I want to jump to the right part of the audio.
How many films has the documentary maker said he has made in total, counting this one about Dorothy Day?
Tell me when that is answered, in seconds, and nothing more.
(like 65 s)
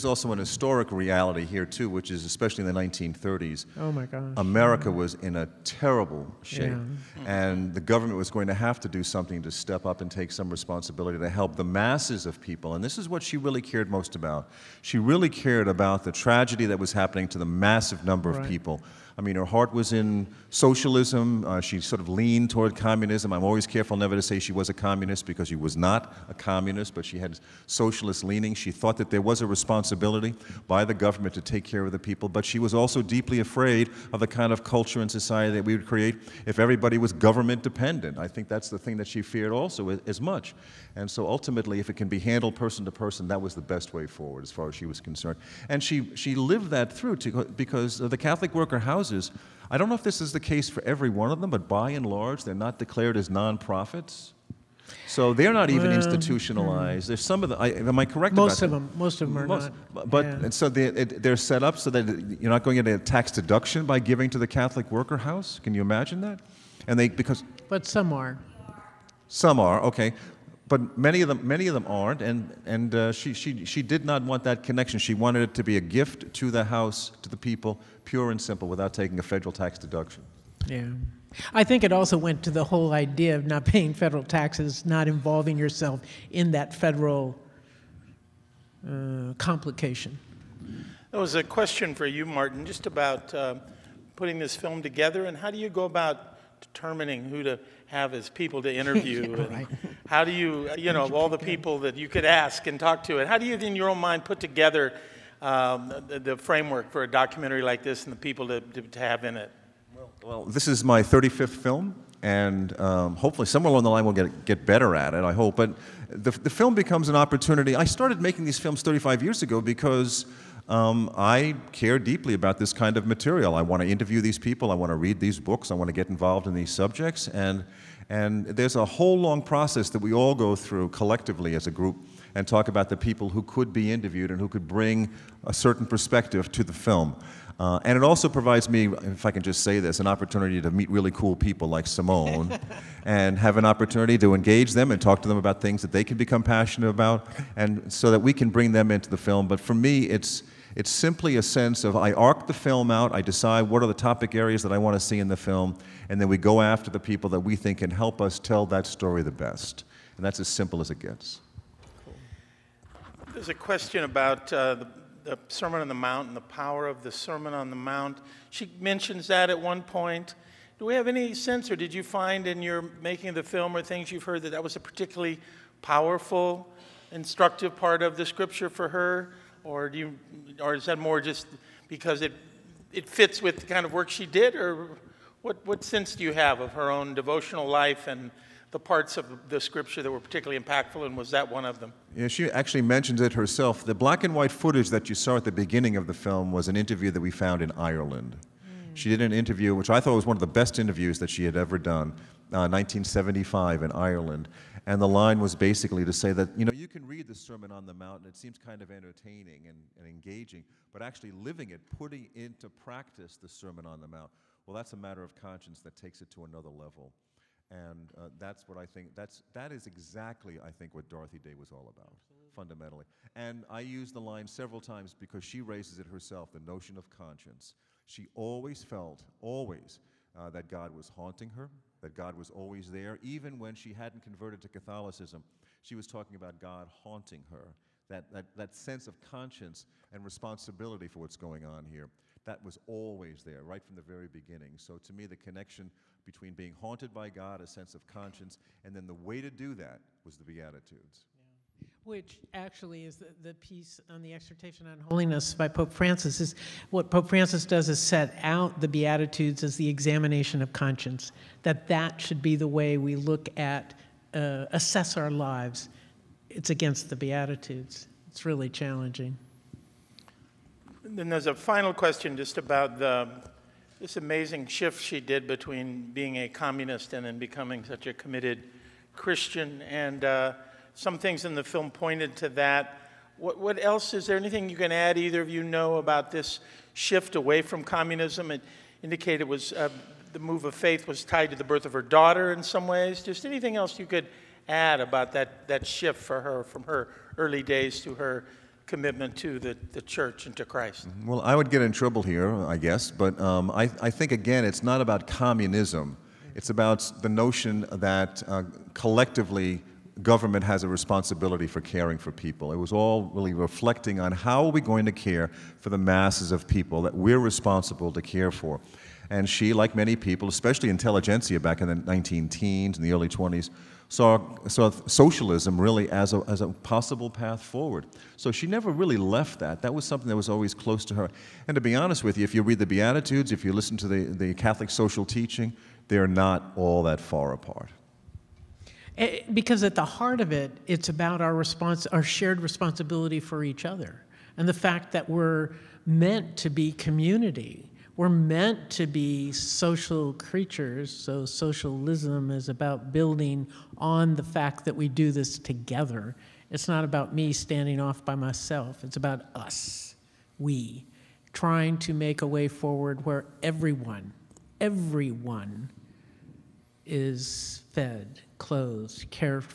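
111 s.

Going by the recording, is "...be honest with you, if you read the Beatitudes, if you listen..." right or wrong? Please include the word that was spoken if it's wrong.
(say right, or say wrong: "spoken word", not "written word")
right.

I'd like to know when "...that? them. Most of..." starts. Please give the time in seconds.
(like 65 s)
58 s.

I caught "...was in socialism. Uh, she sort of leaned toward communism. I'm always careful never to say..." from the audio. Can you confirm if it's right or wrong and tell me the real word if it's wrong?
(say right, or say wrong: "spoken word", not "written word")
right.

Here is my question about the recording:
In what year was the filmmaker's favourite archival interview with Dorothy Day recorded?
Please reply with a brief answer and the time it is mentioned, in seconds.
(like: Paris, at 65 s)
1975, at 202 s.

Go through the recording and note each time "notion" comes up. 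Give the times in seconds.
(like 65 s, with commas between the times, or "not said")
226 s, 307 s.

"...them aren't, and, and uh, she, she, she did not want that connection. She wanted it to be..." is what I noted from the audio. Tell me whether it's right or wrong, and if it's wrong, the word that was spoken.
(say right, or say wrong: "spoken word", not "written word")
right.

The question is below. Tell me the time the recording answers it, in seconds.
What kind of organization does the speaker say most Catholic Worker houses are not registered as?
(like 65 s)
53 s.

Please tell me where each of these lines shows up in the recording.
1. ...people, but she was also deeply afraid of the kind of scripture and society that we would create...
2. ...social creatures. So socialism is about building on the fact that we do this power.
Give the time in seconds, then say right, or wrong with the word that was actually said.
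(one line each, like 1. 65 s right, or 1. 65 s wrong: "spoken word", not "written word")
1. 31 s wrong: "culture", not "scripture"
2. 349 s wrong: "together", not "power".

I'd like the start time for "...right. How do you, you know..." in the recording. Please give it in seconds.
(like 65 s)
99 s.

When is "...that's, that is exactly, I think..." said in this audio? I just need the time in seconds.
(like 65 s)
219 s.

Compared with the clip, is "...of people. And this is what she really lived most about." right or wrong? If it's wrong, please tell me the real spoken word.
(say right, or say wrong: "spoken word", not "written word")
wrong: "cared", not "lived".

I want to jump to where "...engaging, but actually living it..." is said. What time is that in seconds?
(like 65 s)
210 s.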